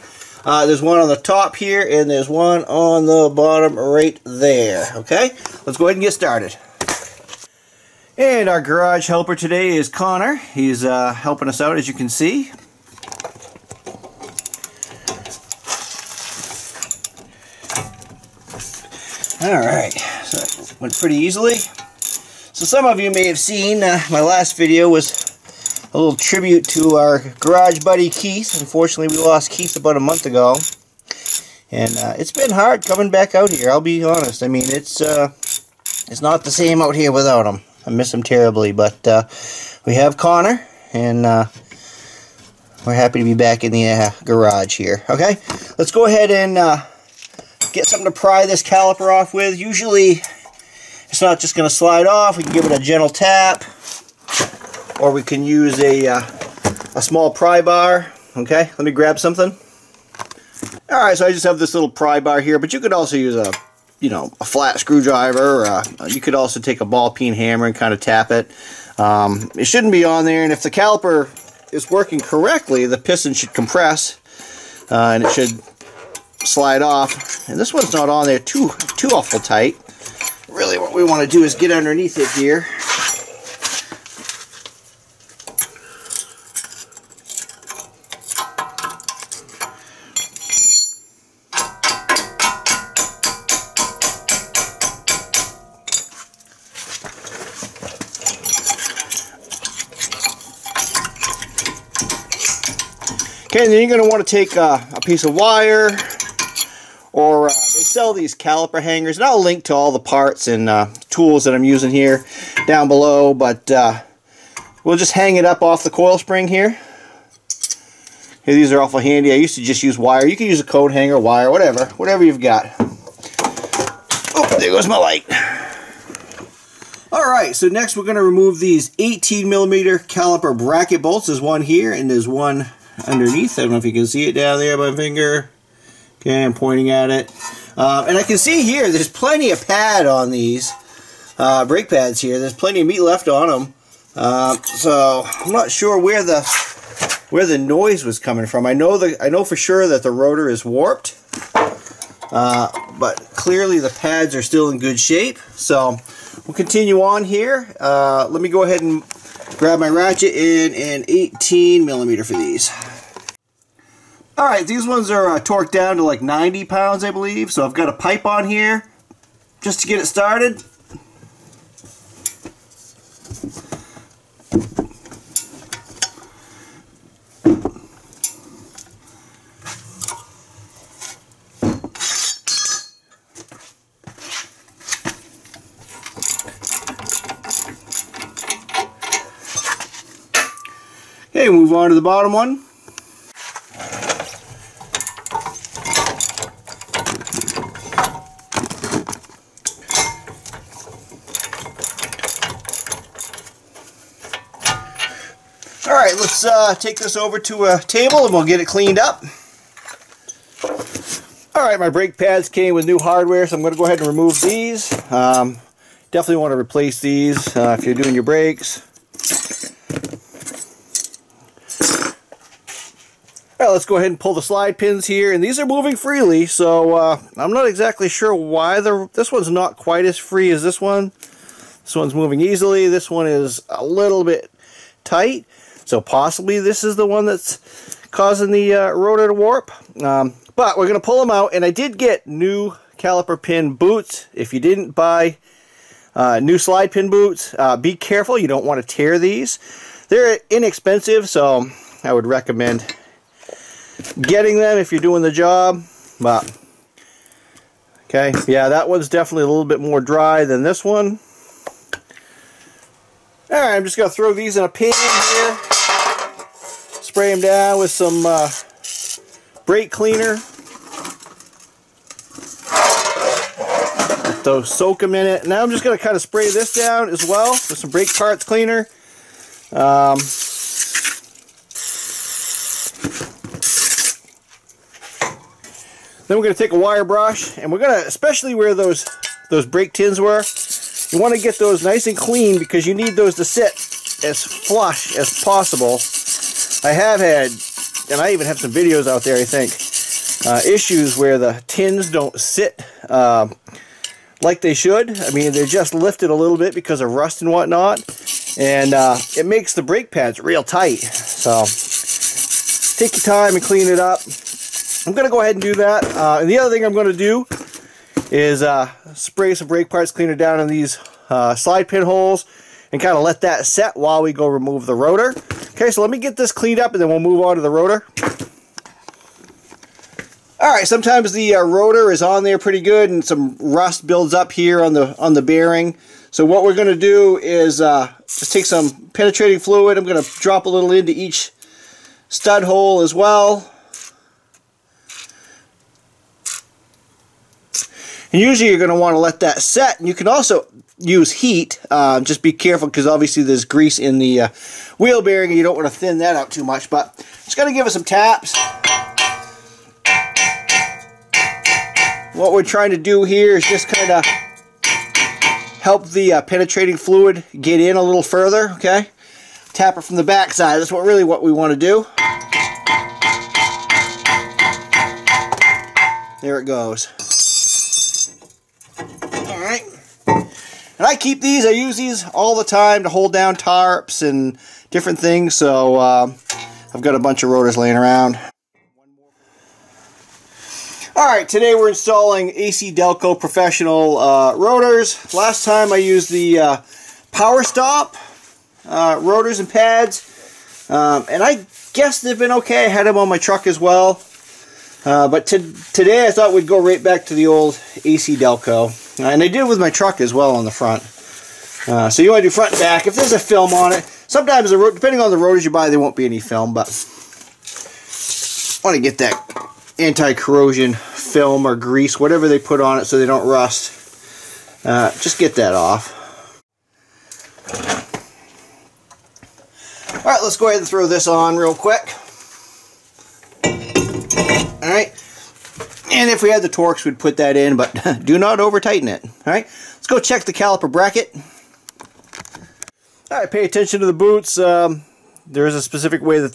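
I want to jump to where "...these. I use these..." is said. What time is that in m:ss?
6:21.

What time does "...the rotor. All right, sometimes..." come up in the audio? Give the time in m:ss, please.
5:27.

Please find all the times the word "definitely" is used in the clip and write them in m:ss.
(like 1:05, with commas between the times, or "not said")
3:36, 4:19.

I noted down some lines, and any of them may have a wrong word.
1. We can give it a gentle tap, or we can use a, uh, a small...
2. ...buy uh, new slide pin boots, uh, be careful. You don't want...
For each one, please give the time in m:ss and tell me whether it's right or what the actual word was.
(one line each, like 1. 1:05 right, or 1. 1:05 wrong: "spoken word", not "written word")
1. 0:52 right
2. 4:04 right.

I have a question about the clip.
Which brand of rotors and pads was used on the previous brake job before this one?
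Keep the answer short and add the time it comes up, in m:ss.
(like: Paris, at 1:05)
Power Stop, at 6:37.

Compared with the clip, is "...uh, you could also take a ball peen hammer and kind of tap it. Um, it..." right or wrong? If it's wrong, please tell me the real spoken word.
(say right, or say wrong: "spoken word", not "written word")
right.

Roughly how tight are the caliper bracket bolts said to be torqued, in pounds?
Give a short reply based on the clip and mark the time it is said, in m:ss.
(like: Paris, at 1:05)
90, at 2:46.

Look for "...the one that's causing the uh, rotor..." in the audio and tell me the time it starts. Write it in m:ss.
3:56.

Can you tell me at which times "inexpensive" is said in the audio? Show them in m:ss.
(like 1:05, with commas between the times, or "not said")
4:10.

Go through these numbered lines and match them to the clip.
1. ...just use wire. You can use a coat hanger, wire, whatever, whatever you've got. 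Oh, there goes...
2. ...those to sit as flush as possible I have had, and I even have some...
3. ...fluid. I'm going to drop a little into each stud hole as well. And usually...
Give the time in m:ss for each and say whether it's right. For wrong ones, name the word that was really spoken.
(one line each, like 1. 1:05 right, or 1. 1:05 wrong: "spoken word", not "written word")
1. 1:59 right
2. 4:53 right
3. 5:39 right.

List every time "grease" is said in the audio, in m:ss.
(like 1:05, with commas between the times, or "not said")
5:53, 7:01.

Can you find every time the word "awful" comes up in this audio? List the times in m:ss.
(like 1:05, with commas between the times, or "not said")
1:19, 1:58.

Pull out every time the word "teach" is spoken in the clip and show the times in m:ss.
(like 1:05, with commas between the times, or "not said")
not said.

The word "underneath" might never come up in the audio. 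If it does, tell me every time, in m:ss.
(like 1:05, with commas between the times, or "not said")
1:21, 2:13.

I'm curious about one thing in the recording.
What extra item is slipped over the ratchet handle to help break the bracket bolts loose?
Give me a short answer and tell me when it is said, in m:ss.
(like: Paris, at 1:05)
A pipe, at 2:47.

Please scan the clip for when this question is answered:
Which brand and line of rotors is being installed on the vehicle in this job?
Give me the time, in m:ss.
6:32.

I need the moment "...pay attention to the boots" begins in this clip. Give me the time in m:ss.
7:23.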